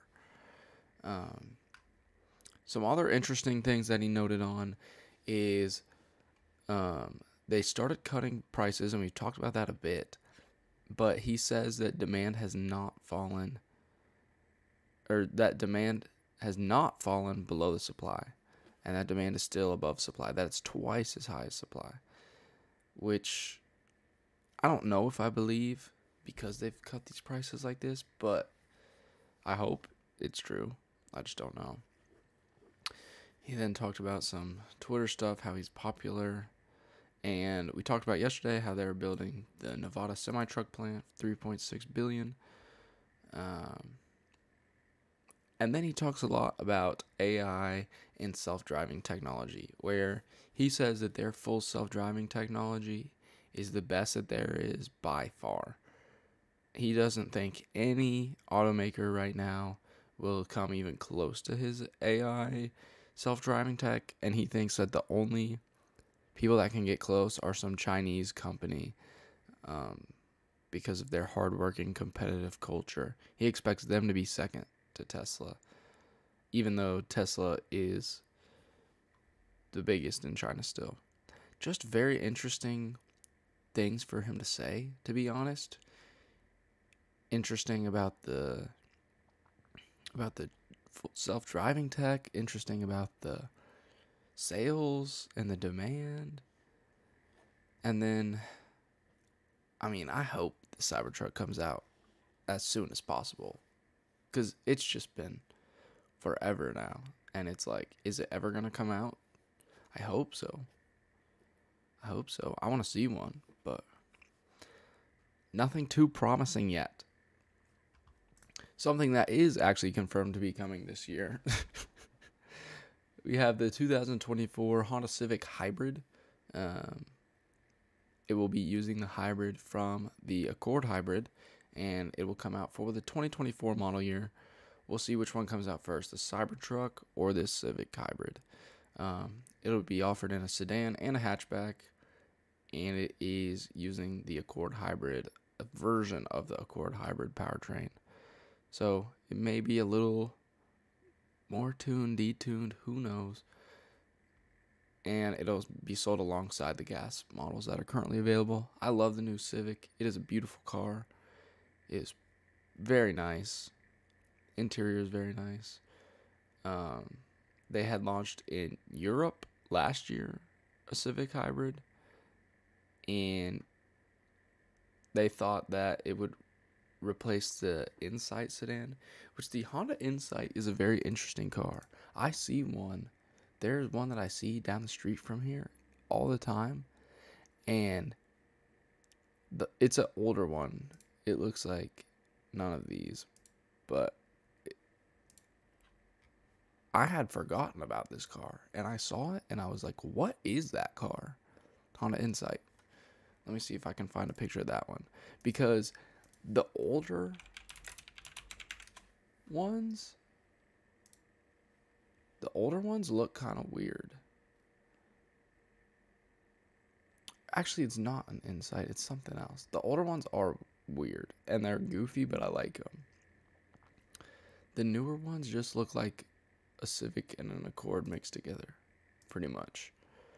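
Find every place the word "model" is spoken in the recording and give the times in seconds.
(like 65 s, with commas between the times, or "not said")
133 s, 157 s.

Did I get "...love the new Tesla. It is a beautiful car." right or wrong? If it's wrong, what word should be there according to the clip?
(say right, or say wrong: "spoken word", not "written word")
wrong: "Civic", not "Tesla".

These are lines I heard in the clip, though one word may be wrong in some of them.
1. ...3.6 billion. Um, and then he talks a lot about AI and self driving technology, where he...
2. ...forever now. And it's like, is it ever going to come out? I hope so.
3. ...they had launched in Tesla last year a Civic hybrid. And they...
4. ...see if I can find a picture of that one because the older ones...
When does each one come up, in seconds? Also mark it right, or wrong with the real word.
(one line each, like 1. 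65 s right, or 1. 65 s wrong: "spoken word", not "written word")
1. 41 s right
2. 106 s right
3. 167 s wrong: "Europe", not "Tesla"
4. 203 s right.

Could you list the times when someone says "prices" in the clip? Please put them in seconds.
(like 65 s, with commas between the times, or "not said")
8 s, 27 s.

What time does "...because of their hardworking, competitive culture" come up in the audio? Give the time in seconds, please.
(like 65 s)
70 s.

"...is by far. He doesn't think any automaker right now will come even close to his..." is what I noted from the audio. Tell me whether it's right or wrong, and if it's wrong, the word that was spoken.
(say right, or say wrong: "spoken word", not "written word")
right.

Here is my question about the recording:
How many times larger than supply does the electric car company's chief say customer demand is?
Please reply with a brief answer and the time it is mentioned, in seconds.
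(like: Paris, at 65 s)
twice as high, at 20 s.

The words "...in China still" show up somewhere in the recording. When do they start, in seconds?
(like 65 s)
80 s.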